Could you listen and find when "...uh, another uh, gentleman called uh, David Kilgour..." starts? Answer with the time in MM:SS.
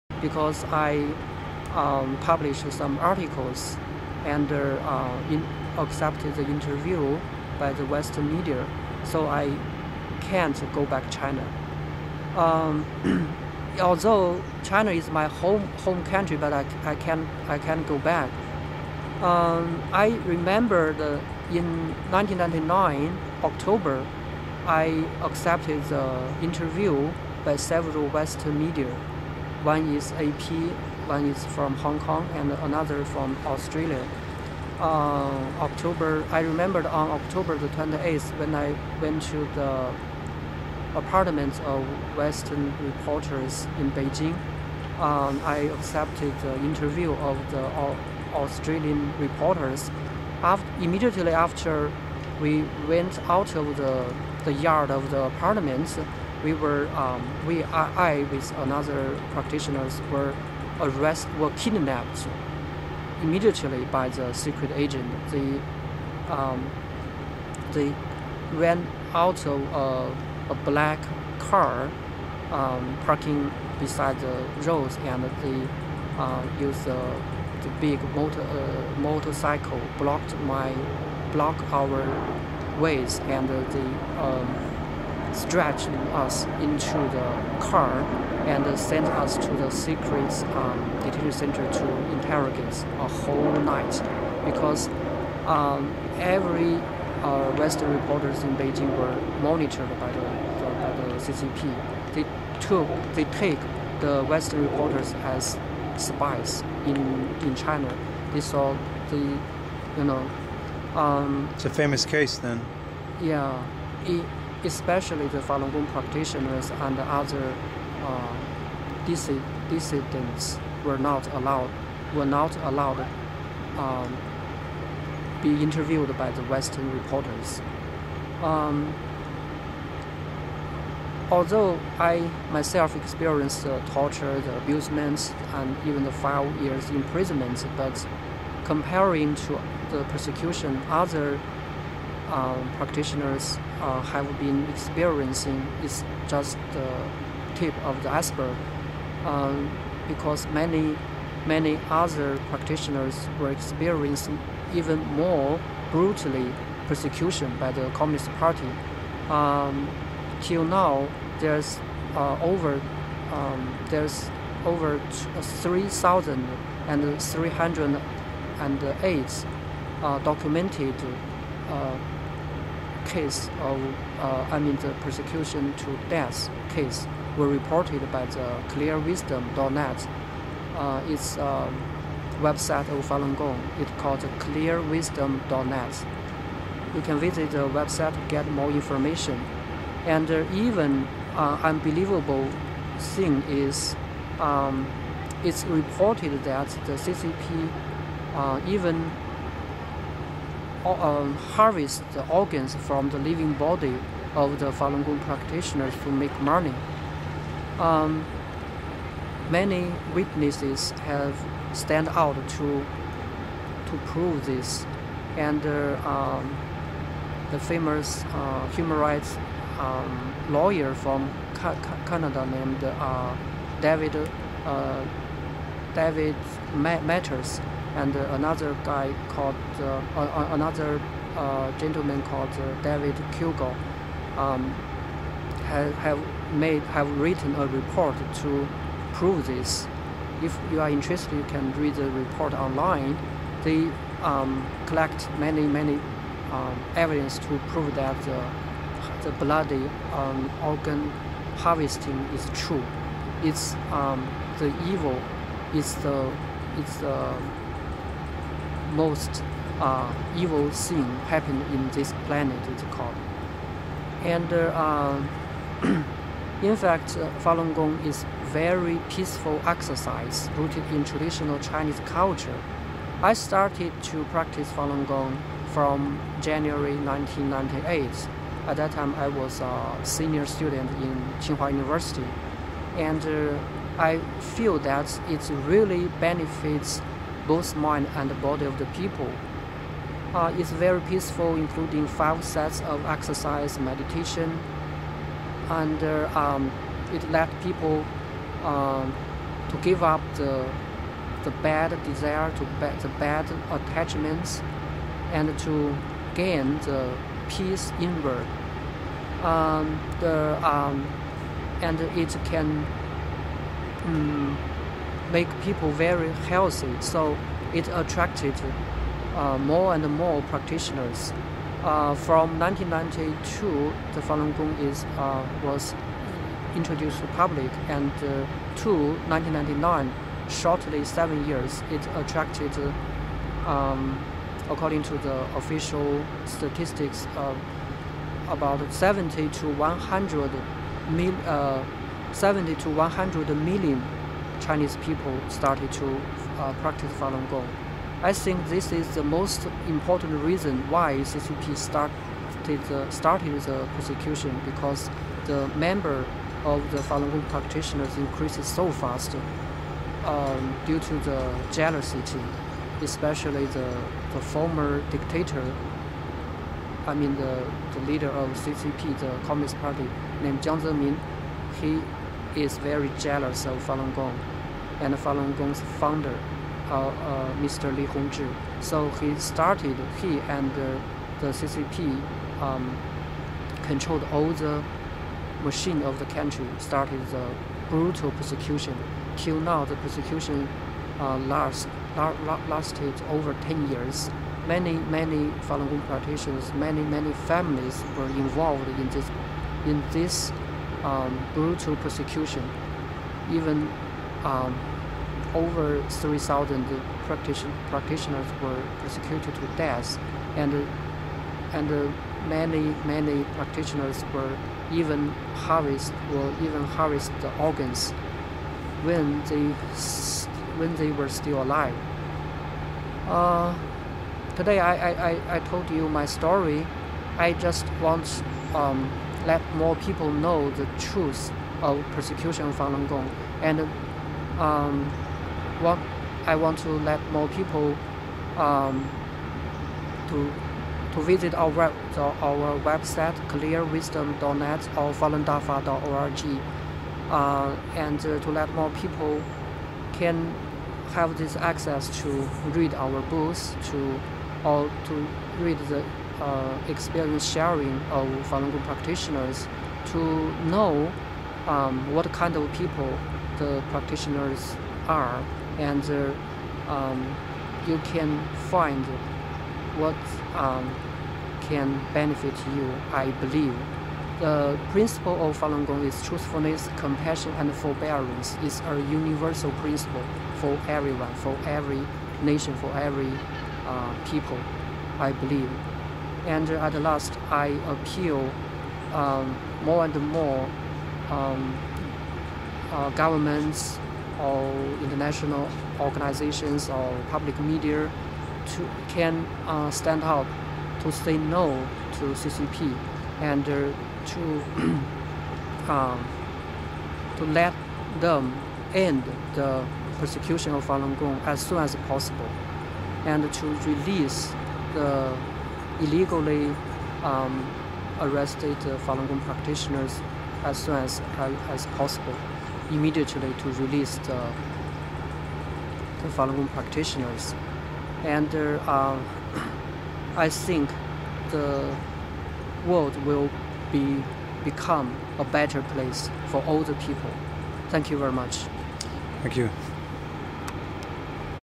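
03:49.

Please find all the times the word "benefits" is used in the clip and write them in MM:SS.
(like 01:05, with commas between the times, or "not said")
04:46, 07:52.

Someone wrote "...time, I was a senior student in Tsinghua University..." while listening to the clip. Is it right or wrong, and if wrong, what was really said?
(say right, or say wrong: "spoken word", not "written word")
right.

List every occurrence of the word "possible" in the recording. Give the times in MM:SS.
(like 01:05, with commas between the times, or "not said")
08:32, 08:41.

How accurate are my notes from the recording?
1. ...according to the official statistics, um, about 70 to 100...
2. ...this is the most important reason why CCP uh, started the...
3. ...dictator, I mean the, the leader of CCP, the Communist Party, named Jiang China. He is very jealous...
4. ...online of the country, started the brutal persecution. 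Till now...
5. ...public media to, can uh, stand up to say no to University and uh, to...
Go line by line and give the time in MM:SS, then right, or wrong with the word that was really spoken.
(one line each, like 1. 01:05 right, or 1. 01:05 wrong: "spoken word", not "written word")
1. 05:34 right
2. 05:48 right
3. 06:05 wrong: "Zemin", not "China"
4. 06:25 wrong: "machine", not "online"
5. 08:17 wrong: "CCP", not "University".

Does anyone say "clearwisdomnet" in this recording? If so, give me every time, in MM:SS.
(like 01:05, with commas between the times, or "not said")
02:58, 03:04, 07:23.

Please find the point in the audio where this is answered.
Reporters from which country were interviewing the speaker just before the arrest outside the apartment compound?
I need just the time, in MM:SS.
00:48.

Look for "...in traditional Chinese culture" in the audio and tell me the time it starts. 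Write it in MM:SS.
04:30.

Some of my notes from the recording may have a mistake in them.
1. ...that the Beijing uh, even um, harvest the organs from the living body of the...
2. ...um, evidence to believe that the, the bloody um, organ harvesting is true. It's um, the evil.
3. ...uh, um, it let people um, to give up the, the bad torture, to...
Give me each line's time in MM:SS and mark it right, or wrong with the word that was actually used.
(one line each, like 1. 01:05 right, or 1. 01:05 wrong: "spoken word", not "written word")
1. 03:16 wrong: "CCP", not "Beijing"
2. 04:06 wrong: "prove", not "believe"
3. 04:56 wrong: "desire", not "torture".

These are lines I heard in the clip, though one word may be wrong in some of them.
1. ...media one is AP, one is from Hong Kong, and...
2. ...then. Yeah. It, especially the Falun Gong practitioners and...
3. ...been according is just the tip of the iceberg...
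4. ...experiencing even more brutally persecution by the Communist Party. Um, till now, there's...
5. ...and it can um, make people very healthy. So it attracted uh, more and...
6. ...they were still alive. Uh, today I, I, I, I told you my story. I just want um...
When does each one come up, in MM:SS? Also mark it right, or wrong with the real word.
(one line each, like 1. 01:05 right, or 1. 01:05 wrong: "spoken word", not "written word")
1. 00:28 right
2. 01:52 right
3. 02:24 wrong: "experiencing", not "according"
4. 02:33 right
5. 05:11 right
6. 07:00 right.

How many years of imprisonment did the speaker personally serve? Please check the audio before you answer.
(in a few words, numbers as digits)
5 years.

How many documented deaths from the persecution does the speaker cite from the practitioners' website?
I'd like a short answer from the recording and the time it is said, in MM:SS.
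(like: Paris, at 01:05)
3,308, at 02:45.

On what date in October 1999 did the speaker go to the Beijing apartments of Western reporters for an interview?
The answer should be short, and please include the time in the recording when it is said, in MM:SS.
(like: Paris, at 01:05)
October 28, at 00:37.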